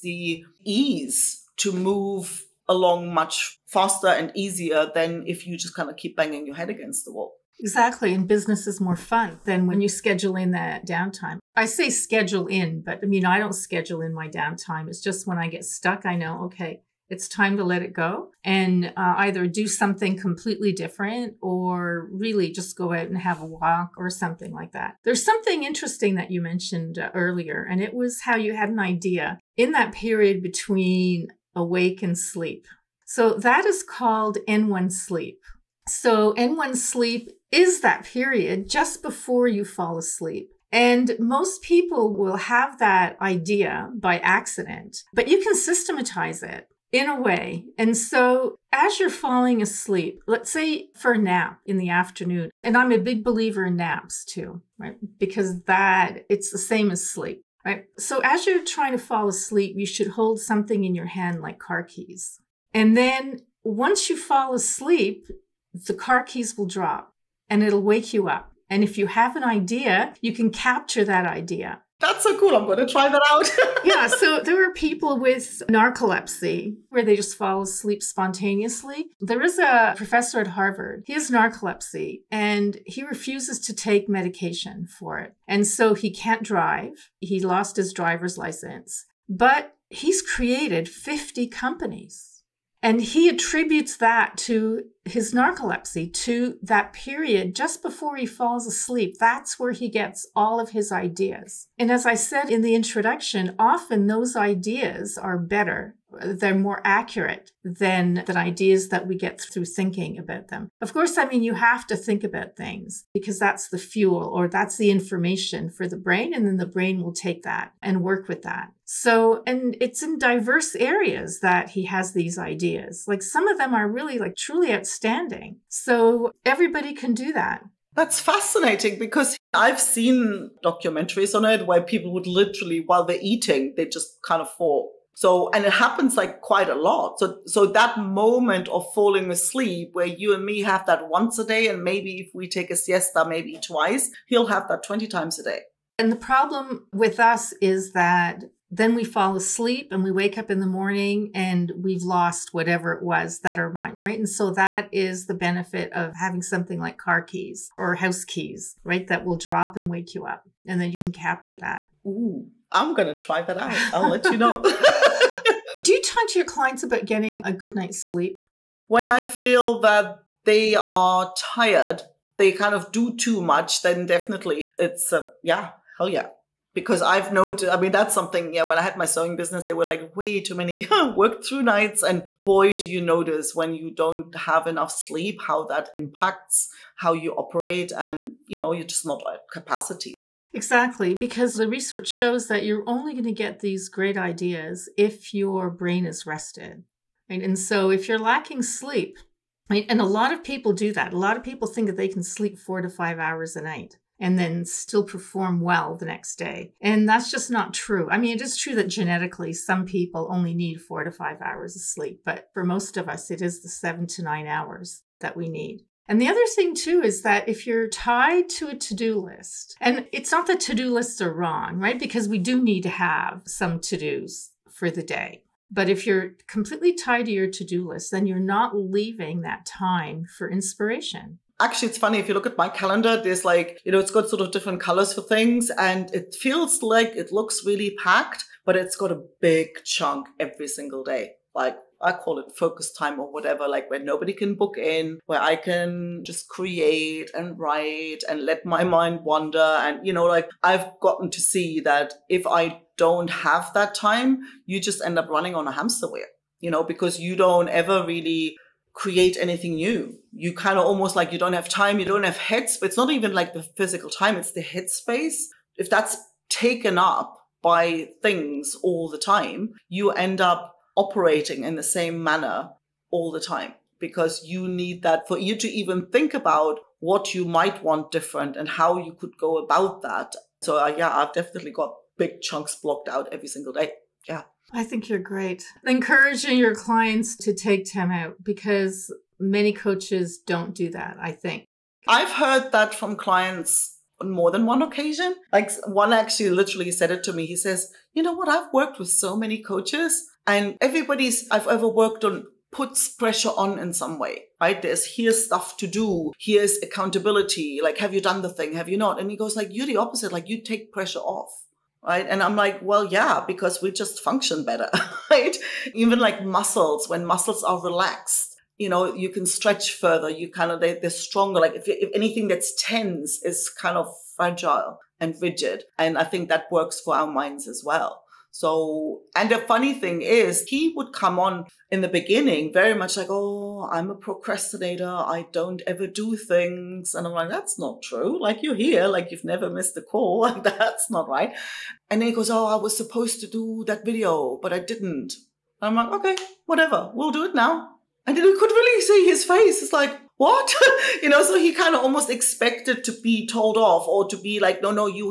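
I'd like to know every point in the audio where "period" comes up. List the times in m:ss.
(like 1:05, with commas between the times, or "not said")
0:29, 0:38, 1:36.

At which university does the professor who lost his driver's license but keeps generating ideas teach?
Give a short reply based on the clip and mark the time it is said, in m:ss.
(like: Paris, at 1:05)
Harvard, at 1:20.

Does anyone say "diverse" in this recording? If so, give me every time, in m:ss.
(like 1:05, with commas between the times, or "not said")
2:00.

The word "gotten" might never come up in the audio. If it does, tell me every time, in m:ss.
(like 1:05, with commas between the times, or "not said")
4:11.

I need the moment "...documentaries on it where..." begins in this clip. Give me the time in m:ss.
2:10.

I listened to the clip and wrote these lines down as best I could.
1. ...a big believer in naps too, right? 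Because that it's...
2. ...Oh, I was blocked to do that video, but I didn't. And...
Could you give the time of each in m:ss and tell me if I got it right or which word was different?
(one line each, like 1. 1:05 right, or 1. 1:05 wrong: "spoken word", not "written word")
1. 0:52 right
2. 5:42 wrong: "supposed", not "blocked".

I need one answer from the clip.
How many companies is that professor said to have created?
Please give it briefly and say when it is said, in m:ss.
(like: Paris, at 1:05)
50, at 1:30.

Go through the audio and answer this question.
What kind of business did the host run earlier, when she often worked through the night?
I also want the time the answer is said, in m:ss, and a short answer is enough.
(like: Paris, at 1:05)
Sewing business, at 2:59.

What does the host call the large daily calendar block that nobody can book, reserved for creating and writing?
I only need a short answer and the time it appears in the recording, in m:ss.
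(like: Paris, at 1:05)
Focus time, at 4:02.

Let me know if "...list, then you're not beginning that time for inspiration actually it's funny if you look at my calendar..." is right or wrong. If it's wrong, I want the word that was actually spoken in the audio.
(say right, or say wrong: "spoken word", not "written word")
wrong: "leaving", not "beginning".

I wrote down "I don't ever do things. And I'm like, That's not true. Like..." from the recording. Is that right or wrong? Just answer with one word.
right.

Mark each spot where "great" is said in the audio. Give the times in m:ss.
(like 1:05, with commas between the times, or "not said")
3:13, 4:45.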